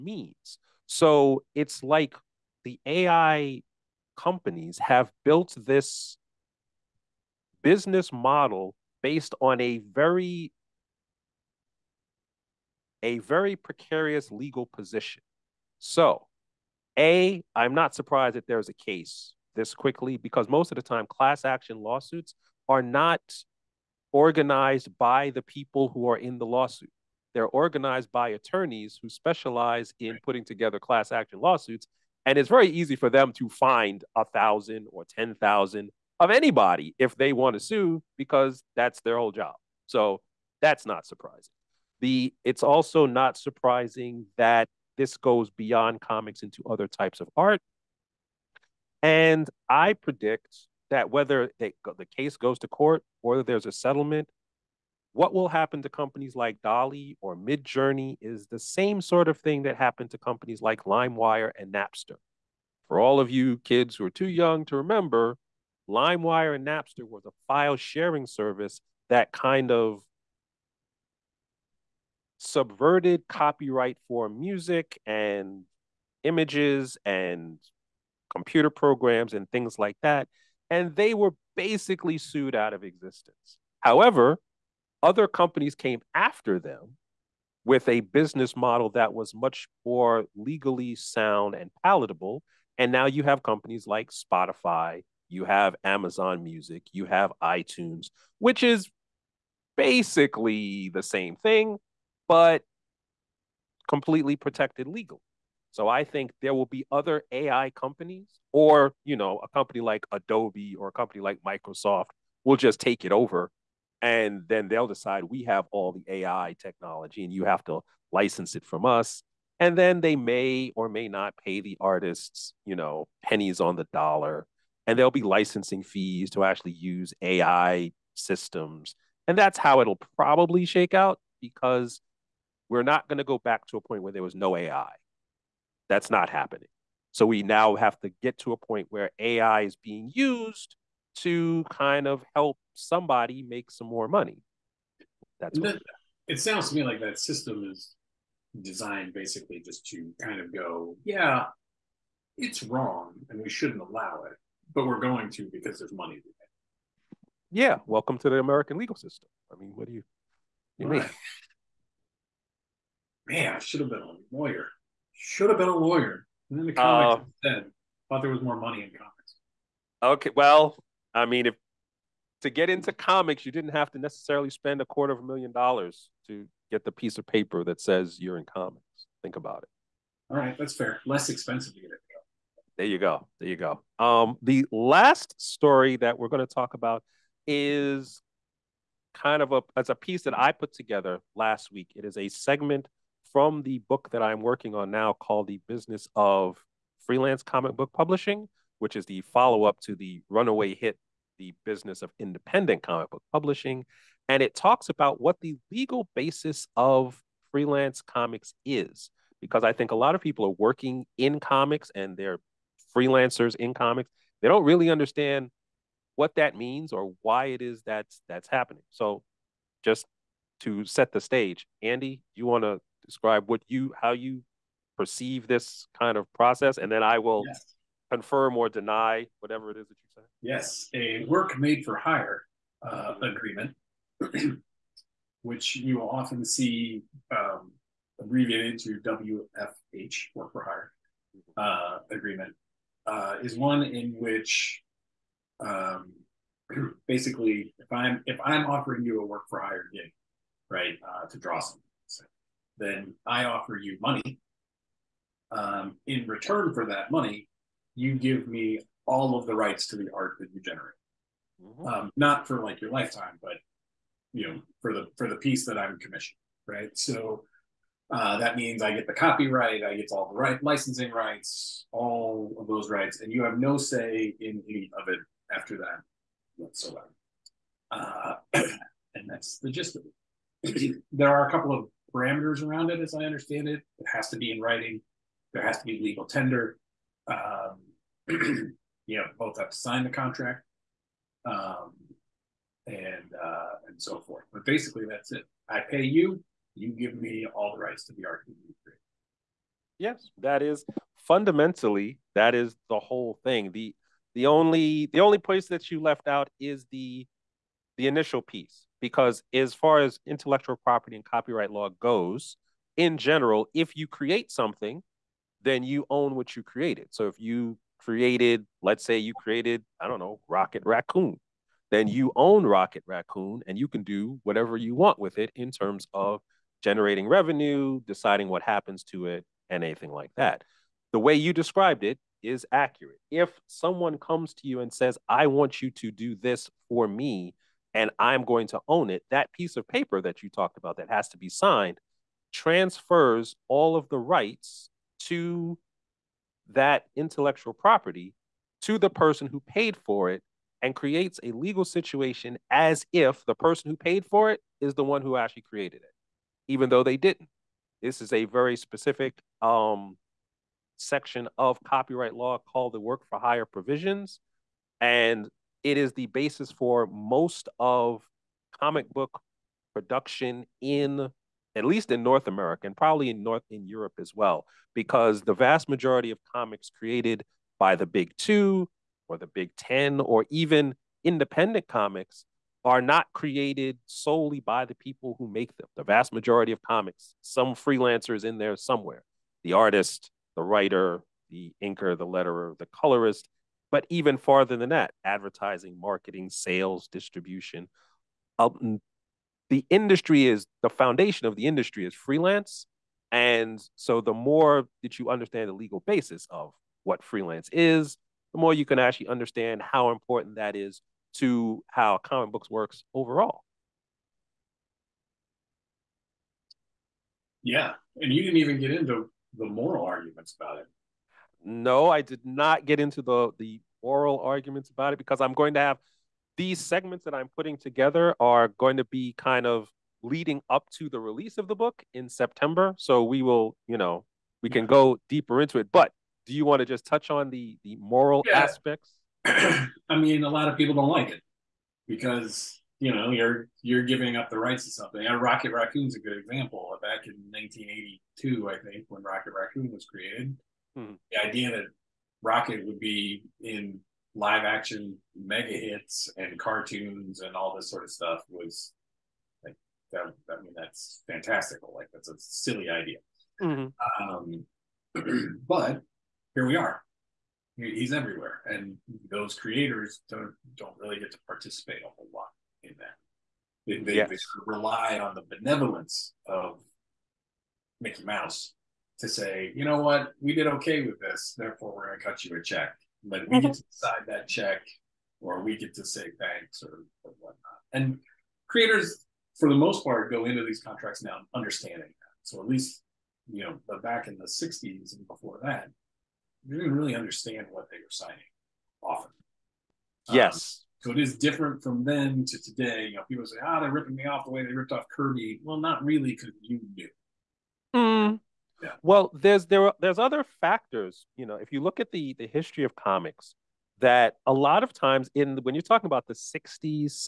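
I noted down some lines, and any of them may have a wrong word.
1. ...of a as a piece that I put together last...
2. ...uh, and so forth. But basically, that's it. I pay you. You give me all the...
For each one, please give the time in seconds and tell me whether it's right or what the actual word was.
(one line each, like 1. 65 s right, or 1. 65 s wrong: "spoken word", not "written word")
1. 189 s right
2. 293 s right.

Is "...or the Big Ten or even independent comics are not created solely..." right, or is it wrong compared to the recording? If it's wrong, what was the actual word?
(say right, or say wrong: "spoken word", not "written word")
right.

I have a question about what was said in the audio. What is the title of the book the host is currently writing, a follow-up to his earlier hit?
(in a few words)
The Business of Freelance Comic Book Publishing.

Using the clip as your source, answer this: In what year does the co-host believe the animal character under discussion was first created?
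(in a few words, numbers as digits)
1982.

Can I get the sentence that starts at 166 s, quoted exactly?
And then the uh, comics uh, thought there was more money in comics.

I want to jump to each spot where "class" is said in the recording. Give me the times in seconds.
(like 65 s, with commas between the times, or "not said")
21 s, 30 s.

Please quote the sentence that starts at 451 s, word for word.
The idea that Rocket would be in live action mega hits and cartoons and all this sort of stuff was like that.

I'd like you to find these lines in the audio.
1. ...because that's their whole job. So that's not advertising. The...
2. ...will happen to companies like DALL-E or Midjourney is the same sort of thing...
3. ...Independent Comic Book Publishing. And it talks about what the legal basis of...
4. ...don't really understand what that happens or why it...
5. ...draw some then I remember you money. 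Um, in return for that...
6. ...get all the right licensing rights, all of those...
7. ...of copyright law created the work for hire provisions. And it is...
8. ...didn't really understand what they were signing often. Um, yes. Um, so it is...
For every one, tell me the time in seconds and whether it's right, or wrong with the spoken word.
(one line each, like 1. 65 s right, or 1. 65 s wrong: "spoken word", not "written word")
1. 38 s wrong: "surprising", not "advertising"
2. 55 s right
3. 202 s right
4. 214 s wrong: "means", not "happens"
5. 251 s wrong: "offer", not "remember"
6. 269 s right
7. 361 s wrong: "called", not "created"
8. 496 s right.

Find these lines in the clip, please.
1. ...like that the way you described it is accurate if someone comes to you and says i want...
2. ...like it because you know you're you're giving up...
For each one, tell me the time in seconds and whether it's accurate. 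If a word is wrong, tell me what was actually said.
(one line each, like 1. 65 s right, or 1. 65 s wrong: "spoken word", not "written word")
1. 330 s right
2. 441 s right.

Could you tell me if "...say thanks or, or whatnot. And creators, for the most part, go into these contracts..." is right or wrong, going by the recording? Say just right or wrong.
right.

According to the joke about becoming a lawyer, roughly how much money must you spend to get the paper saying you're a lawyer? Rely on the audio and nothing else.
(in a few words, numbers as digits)
a quarter of a million dollars.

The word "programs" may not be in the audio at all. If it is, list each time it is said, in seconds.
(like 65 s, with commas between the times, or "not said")
78 s.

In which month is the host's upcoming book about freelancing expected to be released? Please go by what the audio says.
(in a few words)
September.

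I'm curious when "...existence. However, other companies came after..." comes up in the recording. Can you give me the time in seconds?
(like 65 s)
82 s.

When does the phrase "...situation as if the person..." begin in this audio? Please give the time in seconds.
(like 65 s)
351 s.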